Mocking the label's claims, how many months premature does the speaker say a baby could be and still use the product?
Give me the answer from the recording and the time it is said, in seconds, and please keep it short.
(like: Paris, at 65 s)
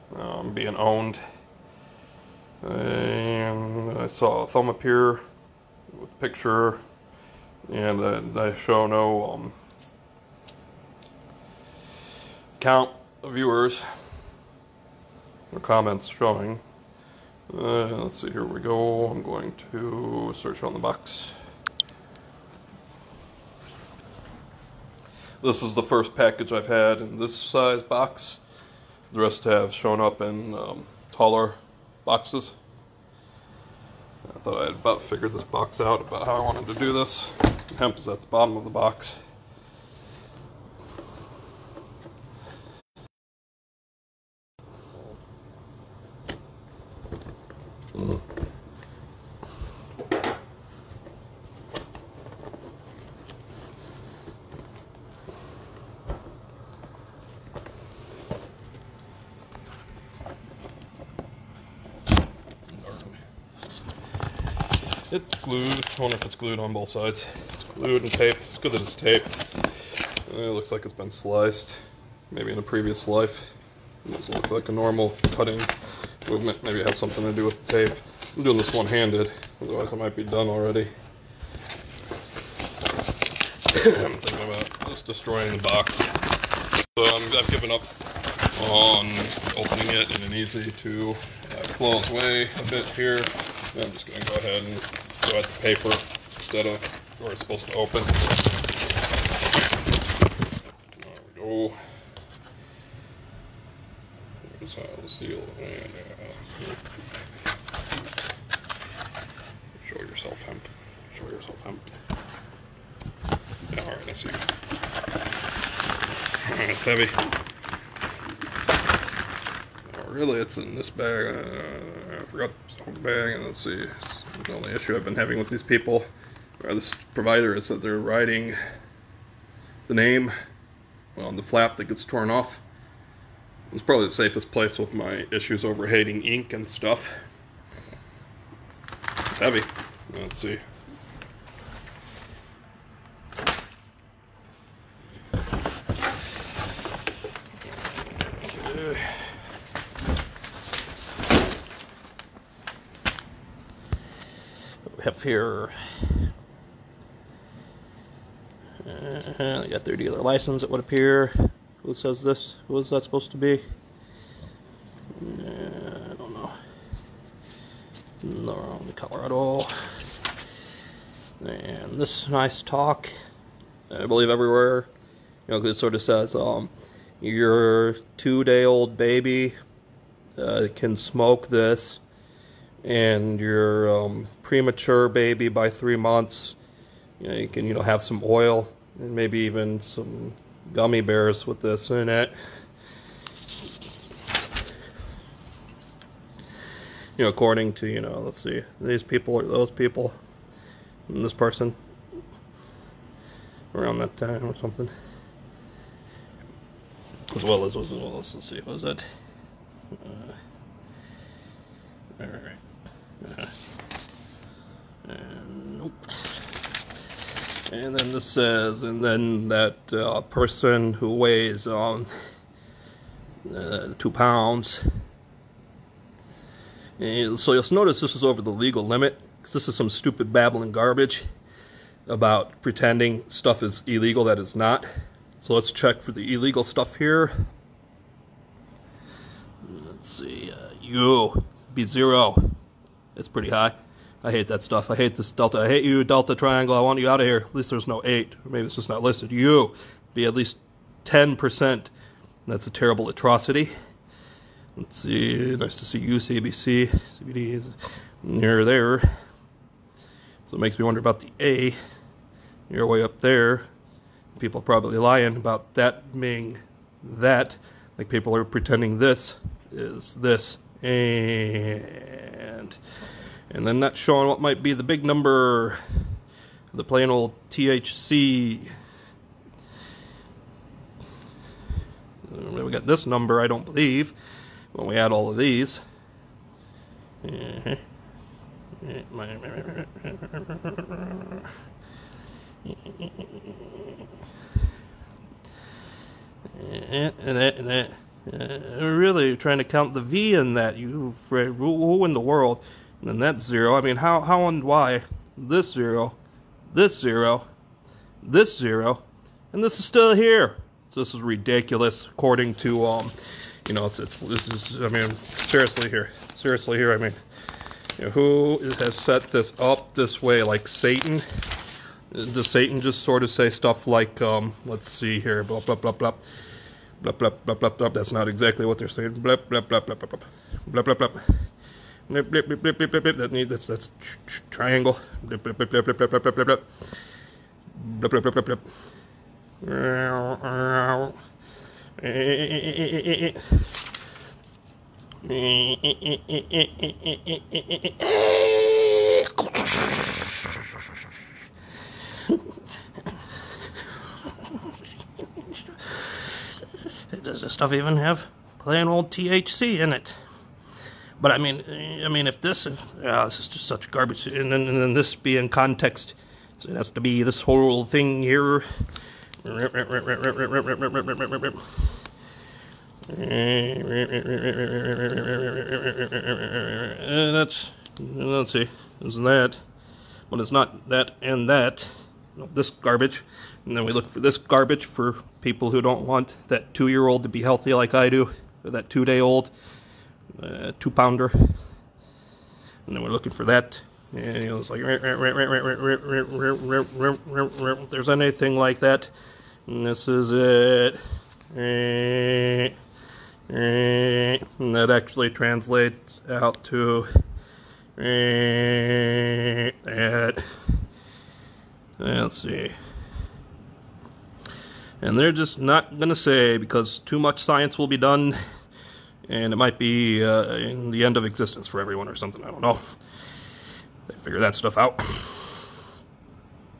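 3, at 185 s.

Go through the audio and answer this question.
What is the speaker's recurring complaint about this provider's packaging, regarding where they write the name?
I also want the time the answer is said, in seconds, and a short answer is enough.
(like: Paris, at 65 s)
On the flap that gets torn off, at 131 s.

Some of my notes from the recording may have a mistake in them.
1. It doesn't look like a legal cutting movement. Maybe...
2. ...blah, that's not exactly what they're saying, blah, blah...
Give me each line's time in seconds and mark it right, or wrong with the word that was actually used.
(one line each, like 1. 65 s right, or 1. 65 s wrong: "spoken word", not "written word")
1. 74 s wrong: "normal", not "legal"
2. 327 s right.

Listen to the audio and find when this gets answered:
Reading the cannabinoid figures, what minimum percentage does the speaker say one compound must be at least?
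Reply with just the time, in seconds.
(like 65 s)
251 s.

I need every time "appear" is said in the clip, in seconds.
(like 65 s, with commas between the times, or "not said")
4 s, 160 s.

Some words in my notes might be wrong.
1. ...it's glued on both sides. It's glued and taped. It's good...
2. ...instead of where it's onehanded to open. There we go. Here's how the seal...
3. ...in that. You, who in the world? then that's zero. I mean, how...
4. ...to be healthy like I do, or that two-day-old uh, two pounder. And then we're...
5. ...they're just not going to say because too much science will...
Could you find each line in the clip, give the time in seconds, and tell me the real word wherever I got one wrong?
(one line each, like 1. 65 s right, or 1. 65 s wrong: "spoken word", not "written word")
1. 66 s right
2. 96 s wrong: "supposed", not "onehanded"
3. 300 s right
4. 387 s right
5. 415 s right.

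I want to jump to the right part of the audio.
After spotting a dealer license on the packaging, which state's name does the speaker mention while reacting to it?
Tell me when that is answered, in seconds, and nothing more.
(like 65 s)
168 s.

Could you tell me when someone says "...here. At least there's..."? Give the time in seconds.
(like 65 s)
247 s.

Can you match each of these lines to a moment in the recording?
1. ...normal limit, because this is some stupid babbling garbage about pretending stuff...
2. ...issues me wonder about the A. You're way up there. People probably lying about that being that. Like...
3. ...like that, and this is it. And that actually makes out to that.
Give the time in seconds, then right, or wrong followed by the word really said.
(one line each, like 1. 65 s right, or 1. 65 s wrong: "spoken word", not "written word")
1. 228 s wrong: "legal", not "normal"
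2. 260 s wrong: "makes", not "issues"
3. 398 s wrong: "translates", not "makes".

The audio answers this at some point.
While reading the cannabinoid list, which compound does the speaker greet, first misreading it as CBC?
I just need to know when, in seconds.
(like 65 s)
257 s.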